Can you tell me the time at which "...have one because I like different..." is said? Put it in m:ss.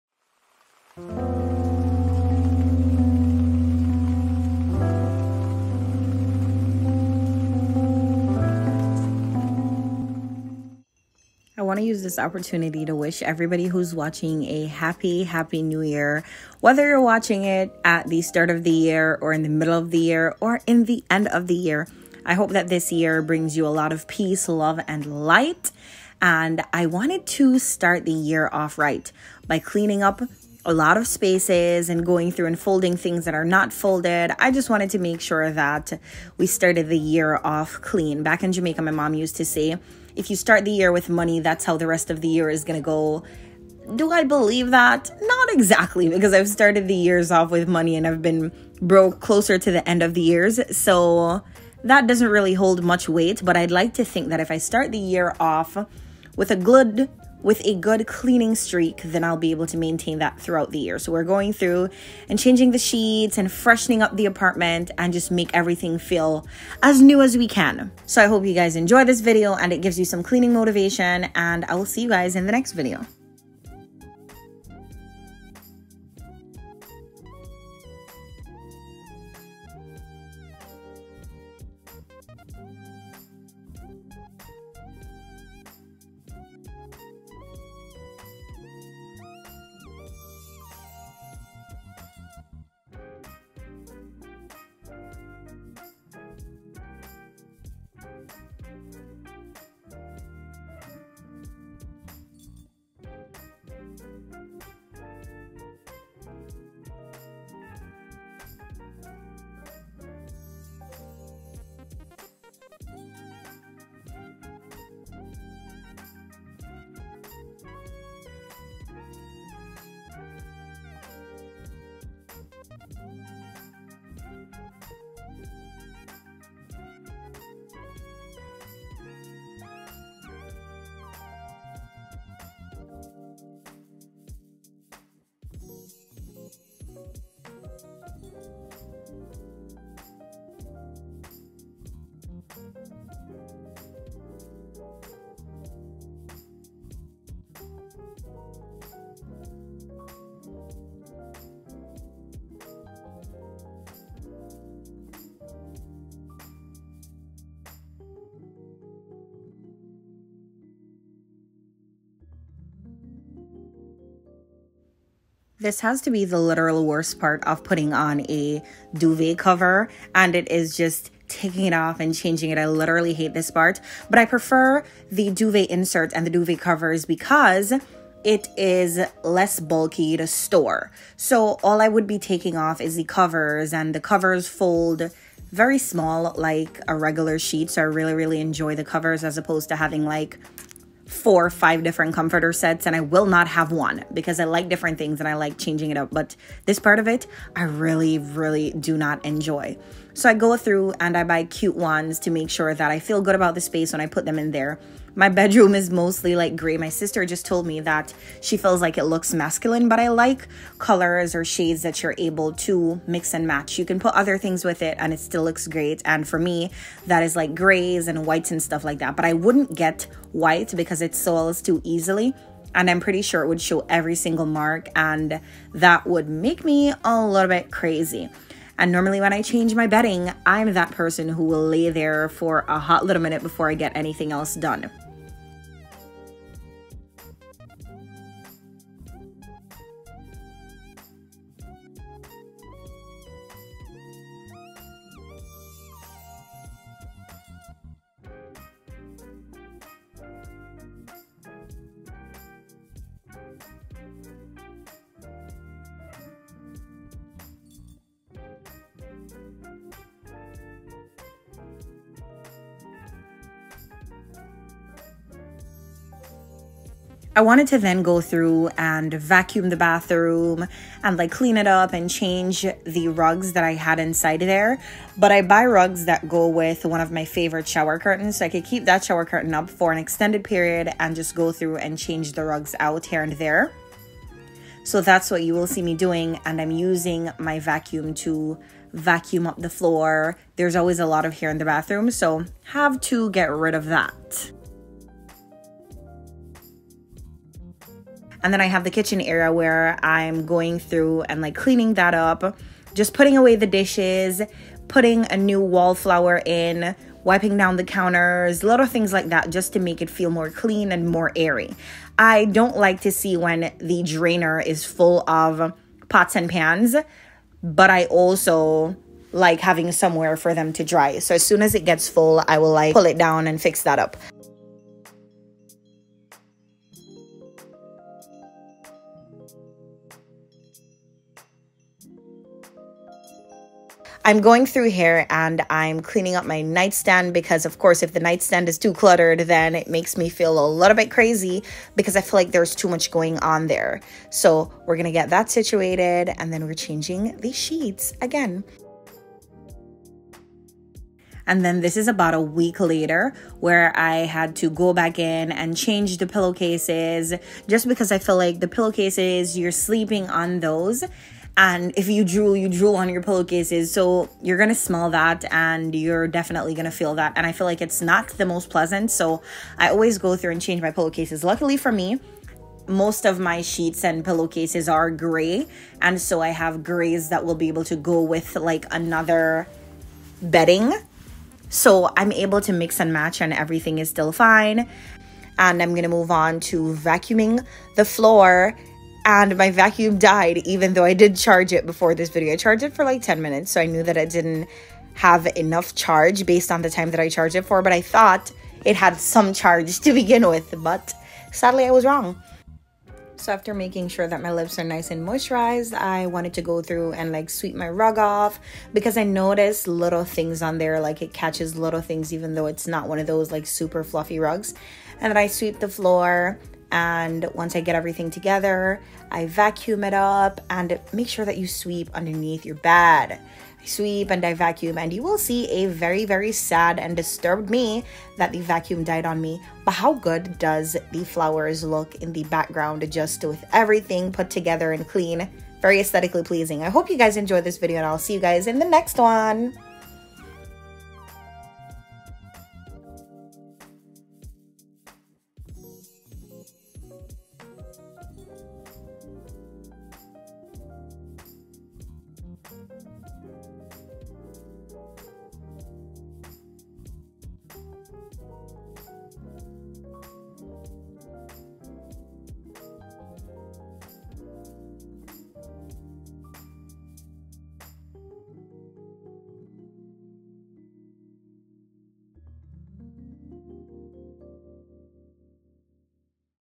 3:13.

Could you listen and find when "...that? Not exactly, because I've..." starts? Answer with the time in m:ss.
0:44.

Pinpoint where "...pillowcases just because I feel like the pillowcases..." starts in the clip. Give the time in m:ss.
5:56.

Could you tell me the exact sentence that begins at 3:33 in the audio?
You can put other things with it and it still looks great.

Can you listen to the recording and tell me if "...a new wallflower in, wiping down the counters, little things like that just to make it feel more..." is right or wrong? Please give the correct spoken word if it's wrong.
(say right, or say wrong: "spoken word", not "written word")
right.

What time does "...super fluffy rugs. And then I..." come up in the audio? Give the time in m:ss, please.
6:53.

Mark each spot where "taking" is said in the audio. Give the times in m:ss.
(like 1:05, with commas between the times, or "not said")
2:51, 3:02.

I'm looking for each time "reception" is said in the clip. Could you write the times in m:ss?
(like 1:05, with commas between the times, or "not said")
not said.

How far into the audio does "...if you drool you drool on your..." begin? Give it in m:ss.
6:01.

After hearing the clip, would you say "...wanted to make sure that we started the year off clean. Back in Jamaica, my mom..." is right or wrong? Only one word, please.
right.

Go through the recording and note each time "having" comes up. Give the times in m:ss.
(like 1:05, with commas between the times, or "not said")
3:09, 5:19.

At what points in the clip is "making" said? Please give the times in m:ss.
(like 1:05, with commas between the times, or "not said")
6:43.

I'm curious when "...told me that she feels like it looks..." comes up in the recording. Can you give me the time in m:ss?
3:27.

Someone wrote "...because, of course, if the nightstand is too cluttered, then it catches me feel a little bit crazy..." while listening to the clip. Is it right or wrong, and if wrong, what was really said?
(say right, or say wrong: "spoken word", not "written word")
wrong: "makes", not "catches".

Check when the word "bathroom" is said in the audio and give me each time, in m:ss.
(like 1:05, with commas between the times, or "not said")
4:29, 4:51.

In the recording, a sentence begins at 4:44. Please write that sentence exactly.
So that's what you will see me doing.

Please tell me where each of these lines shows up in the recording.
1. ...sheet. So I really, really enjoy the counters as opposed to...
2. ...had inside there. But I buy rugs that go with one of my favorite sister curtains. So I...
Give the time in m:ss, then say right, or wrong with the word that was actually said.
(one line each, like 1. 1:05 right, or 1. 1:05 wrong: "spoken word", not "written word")
1. 3:07 wrong: "covers", not "counters"
2. 4:33 wrong: "shower", not "sister".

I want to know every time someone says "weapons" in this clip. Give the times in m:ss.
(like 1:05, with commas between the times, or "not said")
not said.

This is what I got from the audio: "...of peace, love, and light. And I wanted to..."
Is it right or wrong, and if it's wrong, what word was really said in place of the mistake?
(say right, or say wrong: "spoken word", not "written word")
right.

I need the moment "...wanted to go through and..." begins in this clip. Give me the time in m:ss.
6:46.